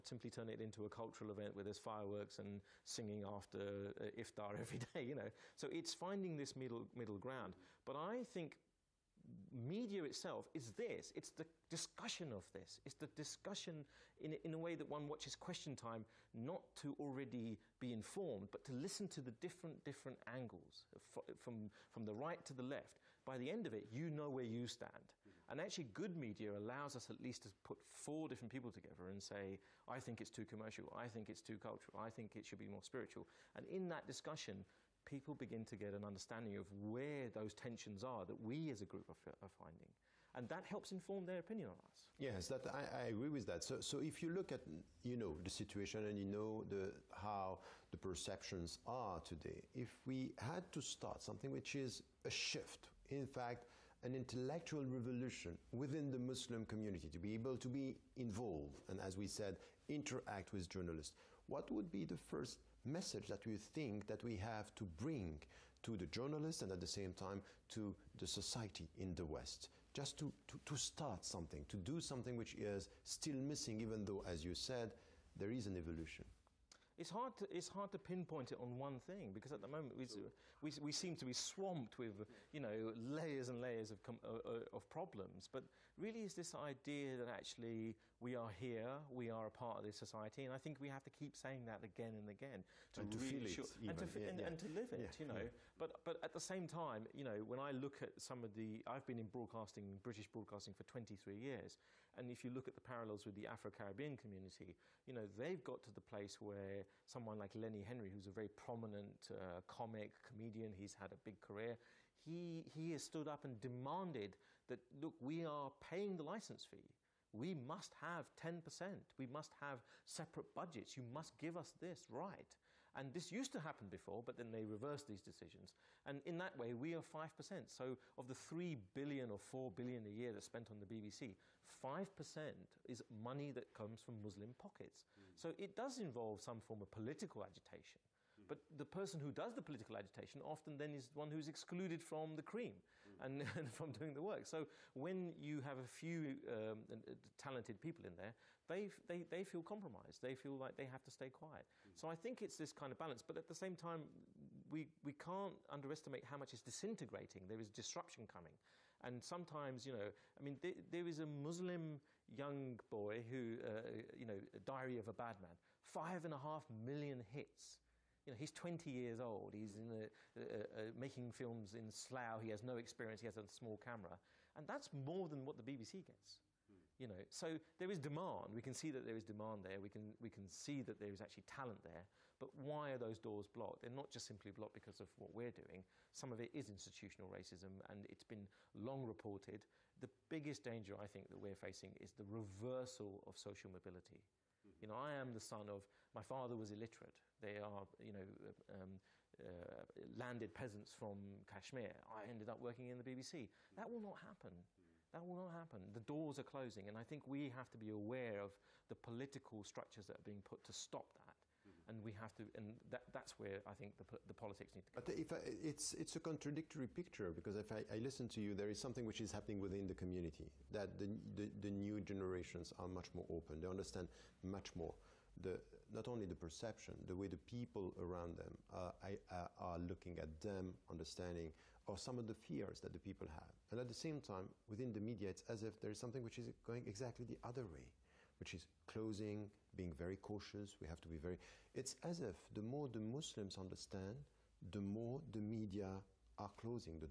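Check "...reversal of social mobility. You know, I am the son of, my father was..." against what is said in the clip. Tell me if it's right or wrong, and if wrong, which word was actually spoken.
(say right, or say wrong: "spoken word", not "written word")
right.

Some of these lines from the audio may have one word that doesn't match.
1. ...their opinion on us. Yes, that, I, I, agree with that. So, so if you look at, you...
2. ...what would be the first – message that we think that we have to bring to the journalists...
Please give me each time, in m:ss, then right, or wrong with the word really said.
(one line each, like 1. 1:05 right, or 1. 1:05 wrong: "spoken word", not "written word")
1. 0:41 right
2. 1:01 right.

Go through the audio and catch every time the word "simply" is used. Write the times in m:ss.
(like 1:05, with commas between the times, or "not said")
0:00, 3:04.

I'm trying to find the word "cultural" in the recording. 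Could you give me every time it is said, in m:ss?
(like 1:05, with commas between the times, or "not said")
0:00, 0:31.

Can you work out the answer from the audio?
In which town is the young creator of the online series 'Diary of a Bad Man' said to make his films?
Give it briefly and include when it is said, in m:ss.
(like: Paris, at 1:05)
Slough, at 2:51.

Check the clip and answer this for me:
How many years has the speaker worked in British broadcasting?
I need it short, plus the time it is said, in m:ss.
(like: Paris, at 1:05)
23, at 1:40.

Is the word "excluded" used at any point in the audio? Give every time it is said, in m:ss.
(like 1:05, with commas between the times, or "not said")
2:21.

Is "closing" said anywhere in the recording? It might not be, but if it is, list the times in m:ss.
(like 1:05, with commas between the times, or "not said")
3:26, 3:58, 4:06.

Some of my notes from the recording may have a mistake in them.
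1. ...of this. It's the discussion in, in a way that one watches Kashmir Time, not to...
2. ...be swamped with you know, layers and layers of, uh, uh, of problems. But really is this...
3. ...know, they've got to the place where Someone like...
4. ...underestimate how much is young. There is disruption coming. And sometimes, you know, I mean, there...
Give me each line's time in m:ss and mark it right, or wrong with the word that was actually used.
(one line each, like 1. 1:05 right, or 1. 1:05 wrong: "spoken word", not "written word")
1. 0:12 wrong: "Question", not "Kashmir"
2. 1:21 right
3. 1:45 right
4. 2:35 wrong: "disintegrating", not "young".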